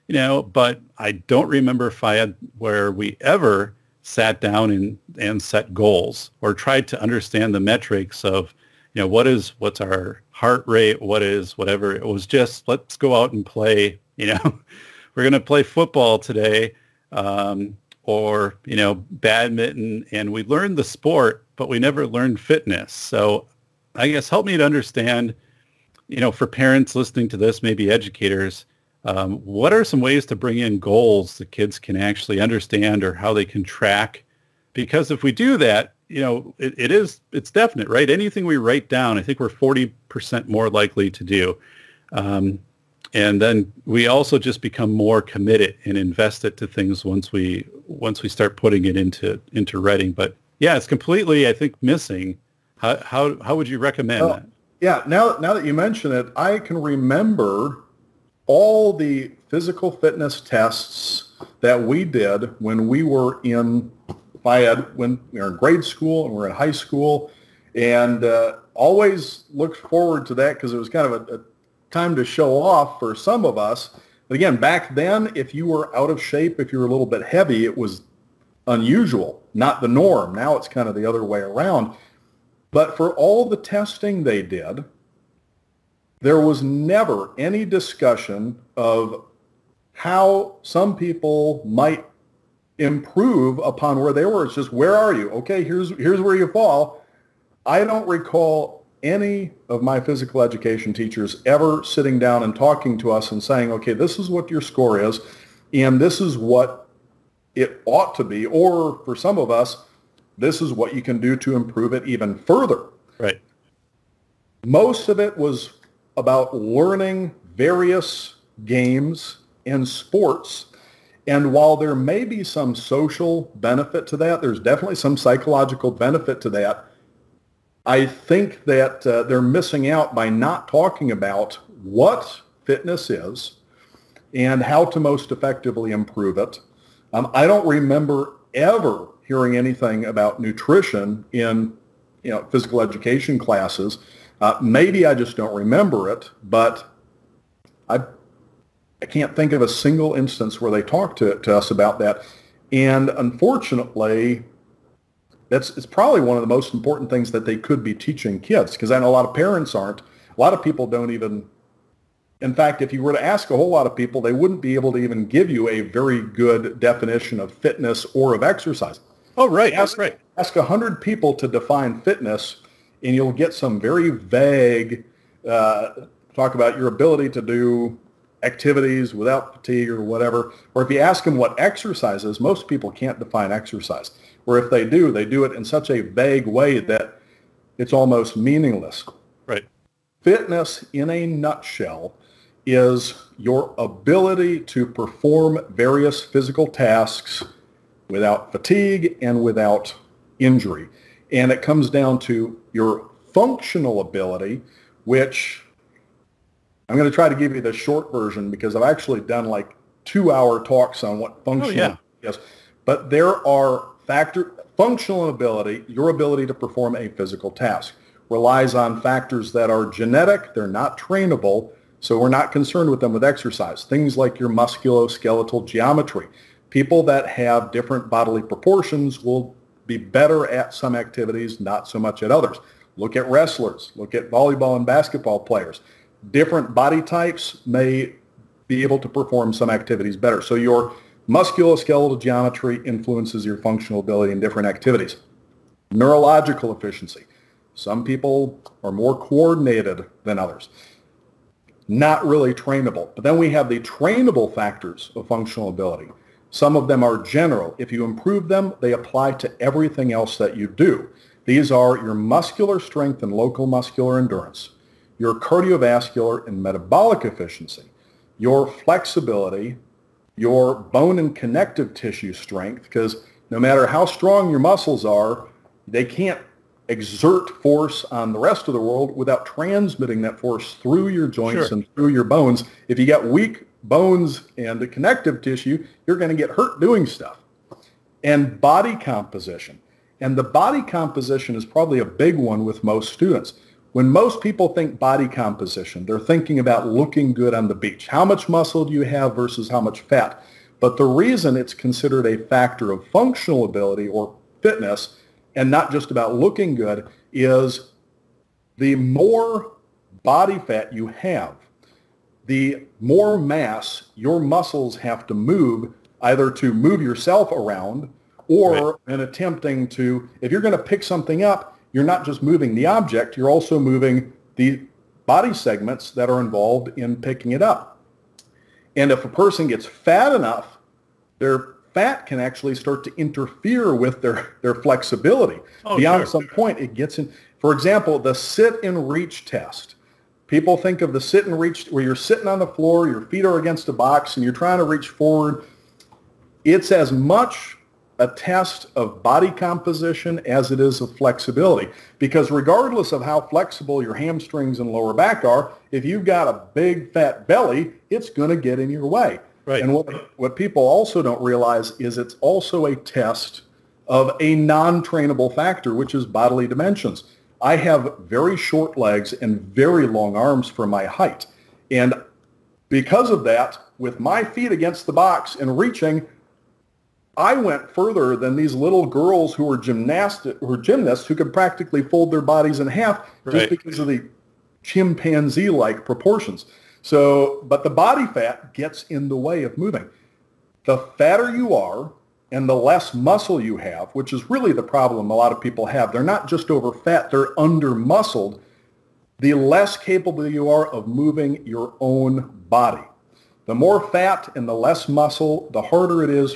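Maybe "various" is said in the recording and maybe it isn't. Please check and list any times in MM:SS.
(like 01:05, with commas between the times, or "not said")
01:57, 03:15.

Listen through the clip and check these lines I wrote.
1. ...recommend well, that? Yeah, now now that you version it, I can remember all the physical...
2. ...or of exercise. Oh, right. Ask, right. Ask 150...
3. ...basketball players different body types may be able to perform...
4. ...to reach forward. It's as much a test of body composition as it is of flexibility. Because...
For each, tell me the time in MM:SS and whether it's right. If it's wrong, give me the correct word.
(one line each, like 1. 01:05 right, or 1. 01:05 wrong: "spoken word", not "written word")
1. 00:53 wrong: "mention", not "version"
2. 02:48 wrong: "100", not "150"
3. 03:54 right
4. 05:44 right.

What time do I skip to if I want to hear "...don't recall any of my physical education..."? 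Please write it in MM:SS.
01:37.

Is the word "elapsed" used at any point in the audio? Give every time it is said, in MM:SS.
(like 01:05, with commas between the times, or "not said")
not said.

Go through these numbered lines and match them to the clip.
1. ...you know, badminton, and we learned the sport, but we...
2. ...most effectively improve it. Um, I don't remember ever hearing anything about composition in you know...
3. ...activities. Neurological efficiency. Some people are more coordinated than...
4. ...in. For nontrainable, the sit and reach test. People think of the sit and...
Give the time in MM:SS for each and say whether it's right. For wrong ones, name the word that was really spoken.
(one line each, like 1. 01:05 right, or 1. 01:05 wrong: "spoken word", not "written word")
1. 00:18 right
2. 02:14 wrong: "nutrition", not "composition"
3. 04:04 right
4. 05:37 wrong: "example", not "nontrainable".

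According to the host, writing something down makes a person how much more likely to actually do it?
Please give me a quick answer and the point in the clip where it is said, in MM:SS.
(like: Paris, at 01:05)
40 percent, at 00:39.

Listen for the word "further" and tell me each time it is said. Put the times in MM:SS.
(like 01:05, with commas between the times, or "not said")
01:52, 06:17.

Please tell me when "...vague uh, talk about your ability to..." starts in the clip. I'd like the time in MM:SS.
02:54.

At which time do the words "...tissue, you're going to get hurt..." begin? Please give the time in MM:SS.
04:45.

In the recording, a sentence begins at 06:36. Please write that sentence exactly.
They're not just over fat, they're under muscled.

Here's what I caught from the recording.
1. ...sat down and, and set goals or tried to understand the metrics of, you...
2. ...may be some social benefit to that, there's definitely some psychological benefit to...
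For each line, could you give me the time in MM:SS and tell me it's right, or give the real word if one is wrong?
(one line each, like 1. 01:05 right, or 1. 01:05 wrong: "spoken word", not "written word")
1. 00:04 right
2. 02:01 right.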